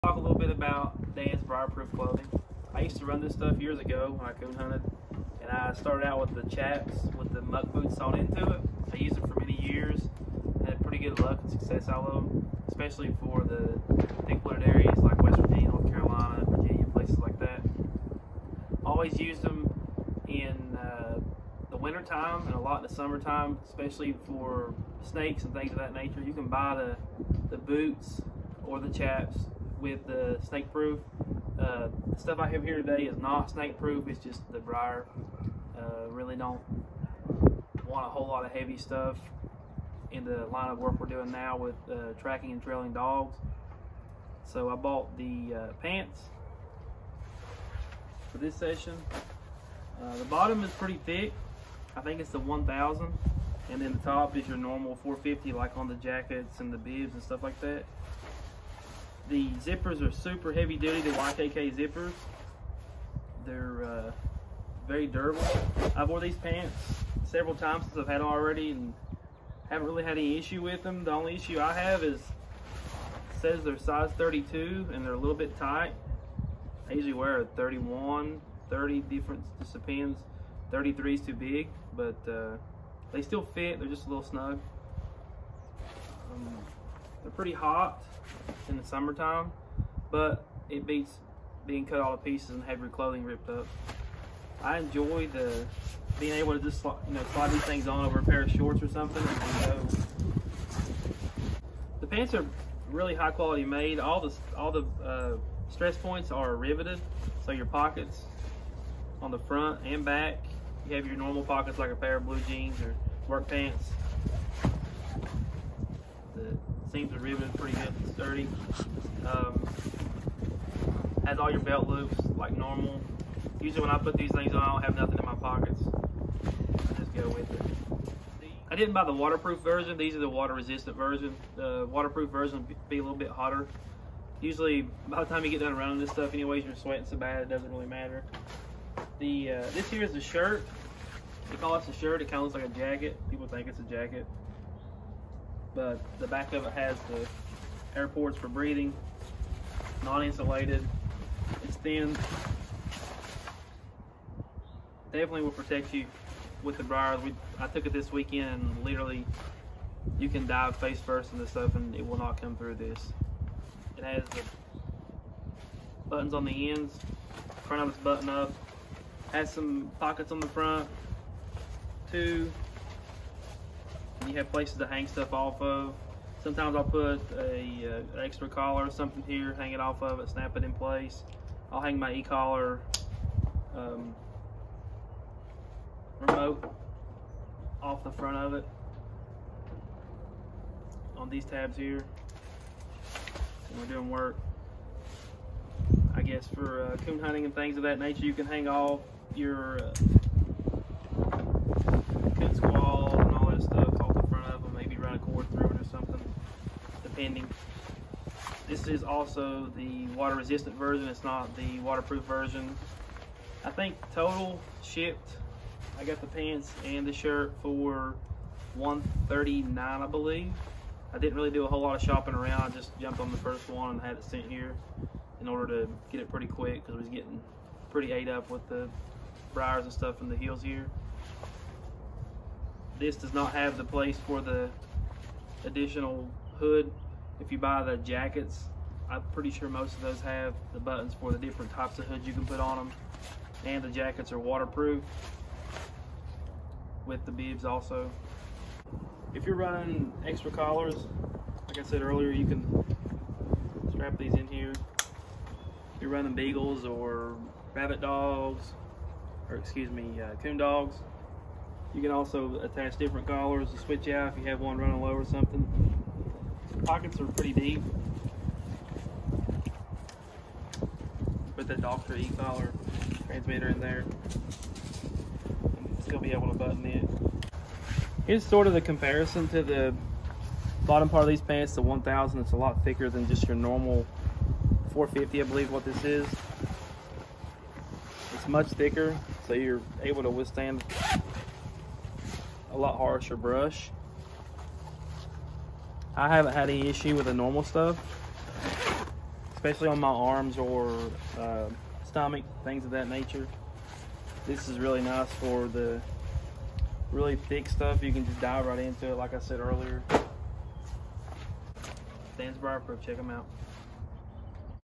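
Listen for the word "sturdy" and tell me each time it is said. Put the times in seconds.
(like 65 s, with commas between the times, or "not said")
118 s.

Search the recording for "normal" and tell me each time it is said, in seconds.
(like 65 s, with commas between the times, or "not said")
54 s, 111 s, 122 s, 283 s, 297 s.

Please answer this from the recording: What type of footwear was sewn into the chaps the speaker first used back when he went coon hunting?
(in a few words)
Muck boots.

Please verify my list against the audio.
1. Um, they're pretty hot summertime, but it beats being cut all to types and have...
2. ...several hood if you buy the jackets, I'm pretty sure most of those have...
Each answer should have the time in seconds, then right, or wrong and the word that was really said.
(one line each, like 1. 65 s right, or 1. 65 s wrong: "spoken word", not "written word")
1. 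86 s wrong: "pieces", not "types"
2. 235 s wrong: "additional", not "several".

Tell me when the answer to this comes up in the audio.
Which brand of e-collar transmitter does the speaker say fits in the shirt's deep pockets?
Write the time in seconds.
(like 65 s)
271 s.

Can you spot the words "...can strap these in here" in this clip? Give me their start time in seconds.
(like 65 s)
252 s.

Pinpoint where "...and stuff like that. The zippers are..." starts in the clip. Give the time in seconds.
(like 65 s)
57 s.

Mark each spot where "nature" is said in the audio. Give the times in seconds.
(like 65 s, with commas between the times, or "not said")
25 s, 197 s, 303 s.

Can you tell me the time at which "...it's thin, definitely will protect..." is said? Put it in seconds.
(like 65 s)
151 s.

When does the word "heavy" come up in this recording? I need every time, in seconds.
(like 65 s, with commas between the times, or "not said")
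38 s, 60 s.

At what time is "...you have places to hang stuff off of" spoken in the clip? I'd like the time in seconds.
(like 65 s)
174 s.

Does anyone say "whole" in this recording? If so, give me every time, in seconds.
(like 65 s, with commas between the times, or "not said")
38 s, 221 s.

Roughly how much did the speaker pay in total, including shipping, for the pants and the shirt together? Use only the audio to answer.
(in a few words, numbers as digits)
$139.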